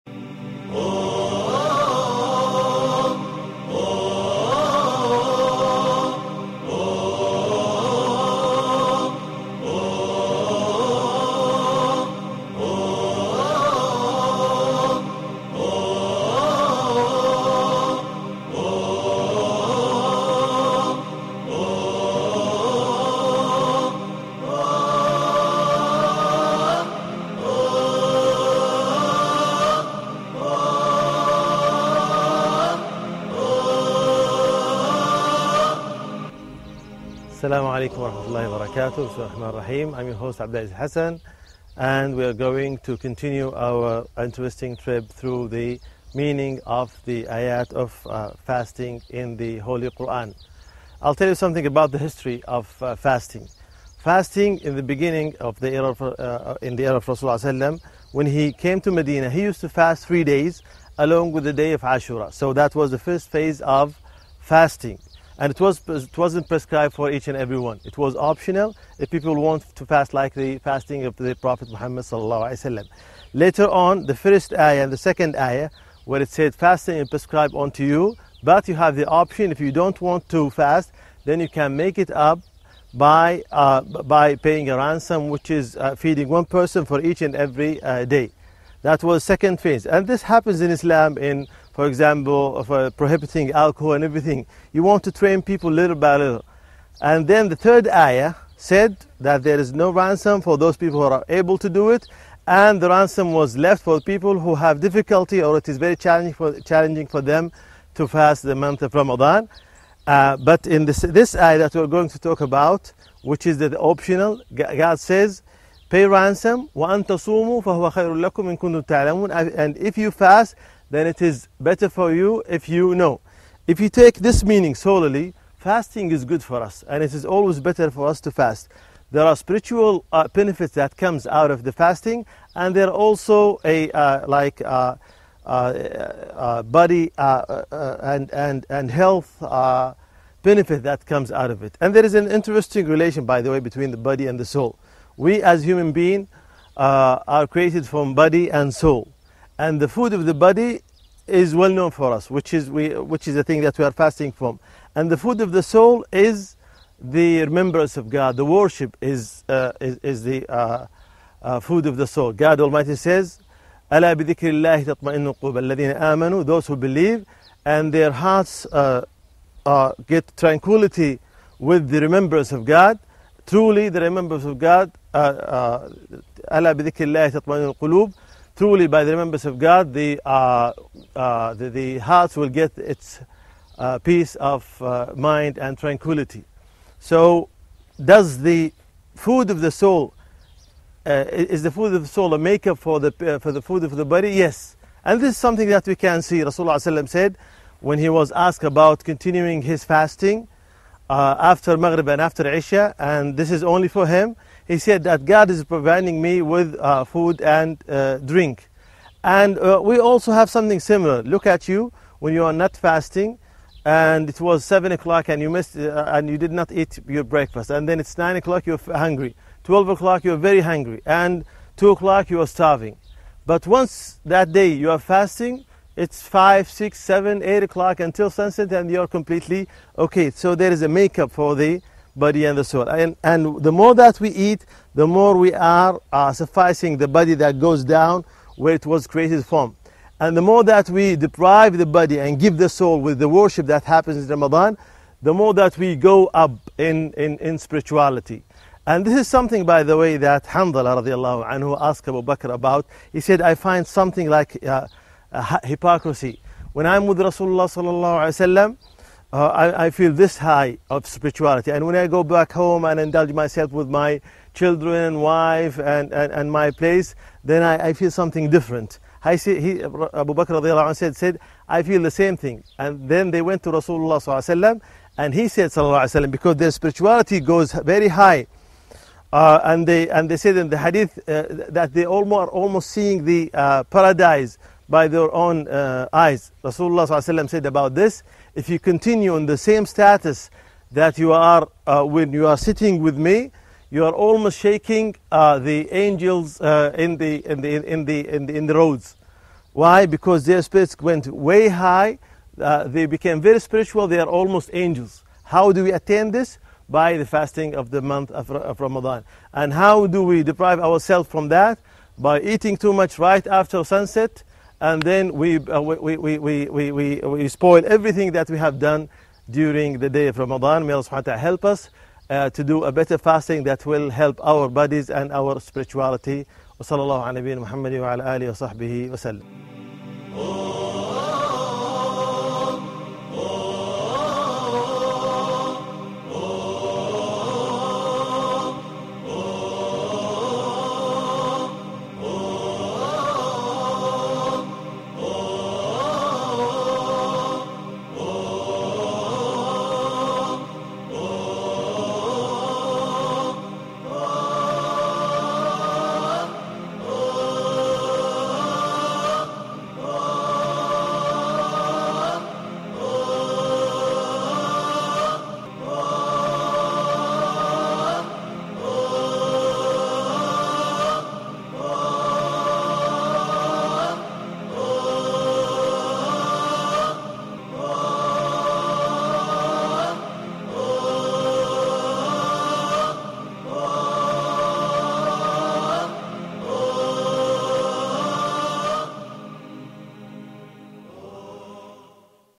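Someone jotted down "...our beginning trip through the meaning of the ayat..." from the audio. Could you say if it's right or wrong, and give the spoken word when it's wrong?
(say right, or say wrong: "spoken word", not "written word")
wrong: "interesting", not "beginning".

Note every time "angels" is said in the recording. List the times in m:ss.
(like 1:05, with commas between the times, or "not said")
4:55, 5:04.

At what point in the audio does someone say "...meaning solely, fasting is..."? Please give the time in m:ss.
2:04.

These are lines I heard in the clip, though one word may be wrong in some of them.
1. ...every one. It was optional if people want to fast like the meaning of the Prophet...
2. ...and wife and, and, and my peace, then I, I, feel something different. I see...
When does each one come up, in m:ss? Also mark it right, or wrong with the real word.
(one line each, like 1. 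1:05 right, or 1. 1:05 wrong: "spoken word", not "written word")
1. 1:07 wrong: "fasting", not "meaning"
2. 4:24 wrong: "place", not "peace".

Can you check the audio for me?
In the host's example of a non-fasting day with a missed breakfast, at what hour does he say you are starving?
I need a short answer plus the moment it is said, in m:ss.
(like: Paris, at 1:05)
2 o'clock, at 3:41.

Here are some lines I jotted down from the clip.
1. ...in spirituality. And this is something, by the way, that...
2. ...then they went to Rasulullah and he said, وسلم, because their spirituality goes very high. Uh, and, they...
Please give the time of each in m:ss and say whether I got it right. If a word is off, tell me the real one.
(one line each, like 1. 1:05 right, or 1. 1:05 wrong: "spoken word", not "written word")
1. 4:07 right
2. 4:33 right.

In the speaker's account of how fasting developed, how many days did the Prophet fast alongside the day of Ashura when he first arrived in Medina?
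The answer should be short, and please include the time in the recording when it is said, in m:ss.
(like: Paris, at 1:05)
3, at 1:00.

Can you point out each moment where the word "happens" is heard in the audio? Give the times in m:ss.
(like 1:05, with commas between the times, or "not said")
1:30, 4:03.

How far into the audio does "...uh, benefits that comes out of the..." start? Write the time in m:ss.
2:10.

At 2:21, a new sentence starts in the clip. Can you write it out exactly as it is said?
And there is an interesting relation, by the way, between the body and the soul.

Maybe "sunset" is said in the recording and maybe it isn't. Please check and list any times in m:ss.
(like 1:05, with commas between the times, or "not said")
3:48, 5:13.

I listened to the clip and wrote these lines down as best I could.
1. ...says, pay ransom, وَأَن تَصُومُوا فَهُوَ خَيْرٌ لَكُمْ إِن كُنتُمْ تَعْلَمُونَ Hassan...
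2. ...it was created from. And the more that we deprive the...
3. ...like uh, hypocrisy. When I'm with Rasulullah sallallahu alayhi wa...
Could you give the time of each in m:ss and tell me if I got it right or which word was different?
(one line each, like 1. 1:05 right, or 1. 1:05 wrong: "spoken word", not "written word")
1. 1:54 wrong: "And", not "Hassan"
2. 3:58 right
3. 4:14 right.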